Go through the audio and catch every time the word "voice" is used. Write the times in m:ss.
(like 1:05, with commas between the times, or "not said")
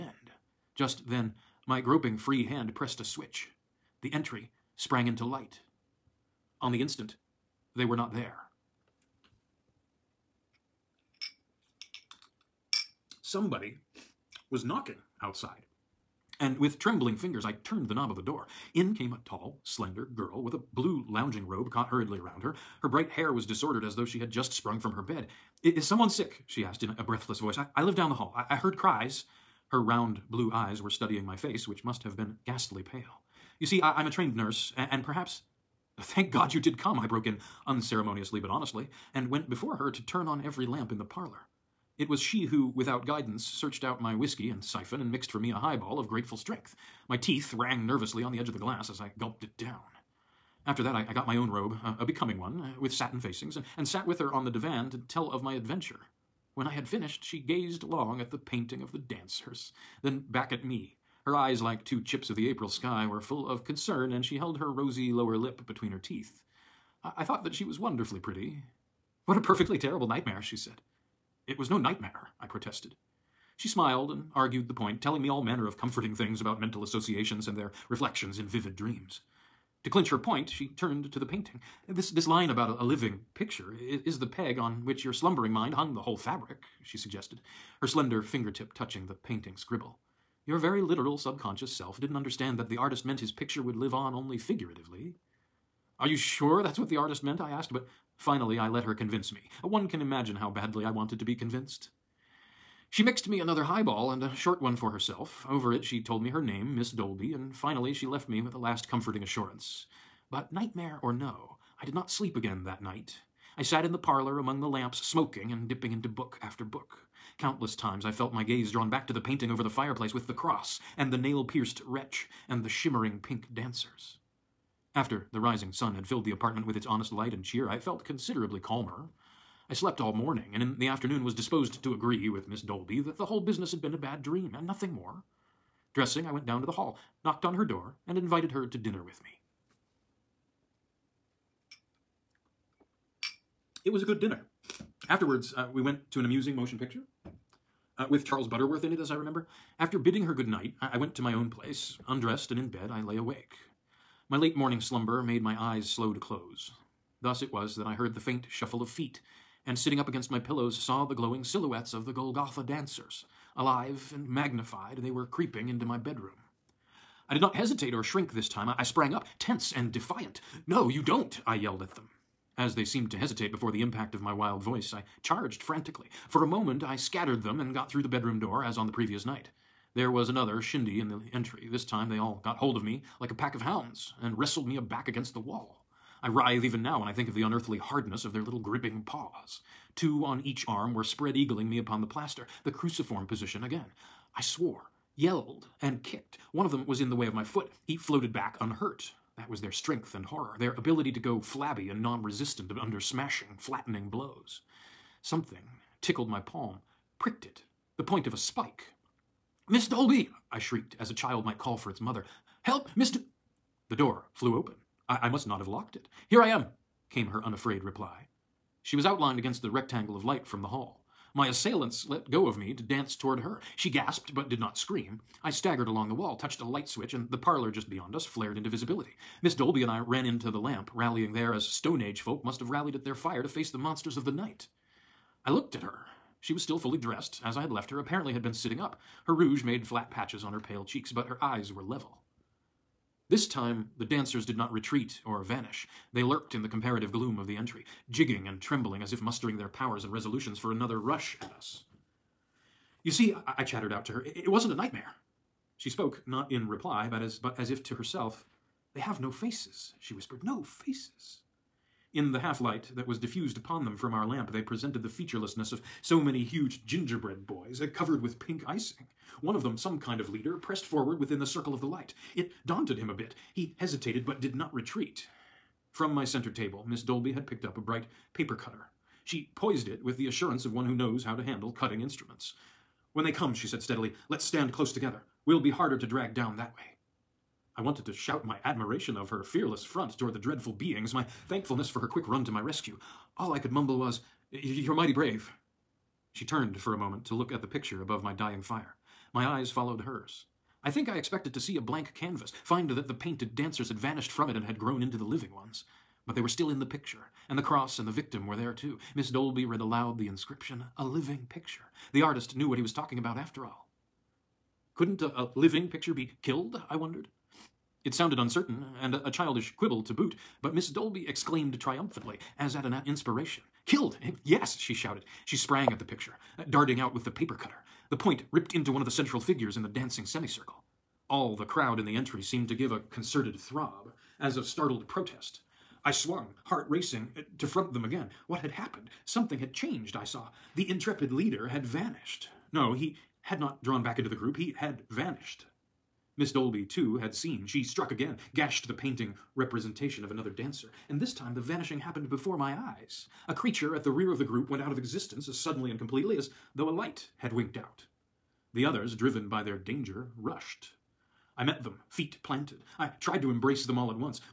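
0:27, 2:54.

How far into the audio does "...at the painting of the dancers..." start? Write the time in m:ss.
0:58.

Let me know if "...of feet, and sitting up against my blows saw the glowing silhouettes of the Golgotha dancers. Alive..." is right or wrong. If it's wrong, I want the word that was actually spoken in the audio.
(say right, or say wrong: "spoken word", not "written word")
wrong: "pillows", not "blows".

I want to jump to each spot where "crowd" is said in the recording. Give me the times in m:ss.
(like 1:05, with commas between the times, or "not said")
5:31.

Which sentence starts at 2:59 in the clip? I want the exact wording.
There was another shindy in the entry.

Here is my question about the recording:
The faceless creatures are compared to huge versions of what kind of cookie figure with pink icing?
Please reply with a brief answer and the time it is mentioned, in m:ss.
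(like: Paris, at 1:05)
Gingerbread boys, at 4:26.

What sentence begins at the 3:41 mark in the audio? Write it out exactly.
My assailants let go of me to dance toward her.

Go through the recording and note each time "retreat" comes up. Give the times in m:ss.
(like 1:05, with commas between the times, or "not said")
4:04, 4:34.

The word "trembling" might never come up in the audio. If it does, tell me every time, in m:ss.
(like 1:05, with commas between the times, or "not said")
0:16, 4:08.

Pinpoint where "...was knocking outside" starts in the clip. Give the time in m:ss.
0:14.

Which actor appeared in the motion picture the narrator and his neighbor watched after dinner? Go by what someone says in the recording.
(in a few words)
Charles Butterworth.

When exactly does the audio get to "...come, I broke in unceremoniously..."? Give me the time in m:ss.
0:36.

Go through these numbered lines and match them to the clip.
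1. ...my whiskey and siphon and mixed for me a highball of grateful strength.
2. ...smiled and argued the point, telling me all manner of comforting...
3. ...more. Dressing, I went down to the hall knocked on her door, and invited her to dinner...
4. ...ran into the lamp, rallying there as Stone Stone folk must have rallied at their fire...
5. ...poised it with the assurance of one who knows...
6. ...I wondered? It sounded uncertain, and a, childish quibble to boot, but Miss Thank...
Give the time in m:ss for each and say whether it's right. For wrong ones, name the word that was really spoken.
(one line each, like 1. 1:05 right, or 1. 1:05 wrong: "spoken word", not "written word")
1. 0:44 right
2. 1:13 right
3. 2:14 right
4. 3:49 wrong: "Age", not "Stone"
5. 4:39 right
6. 5:16 wrong: "Dolby", not "Thank".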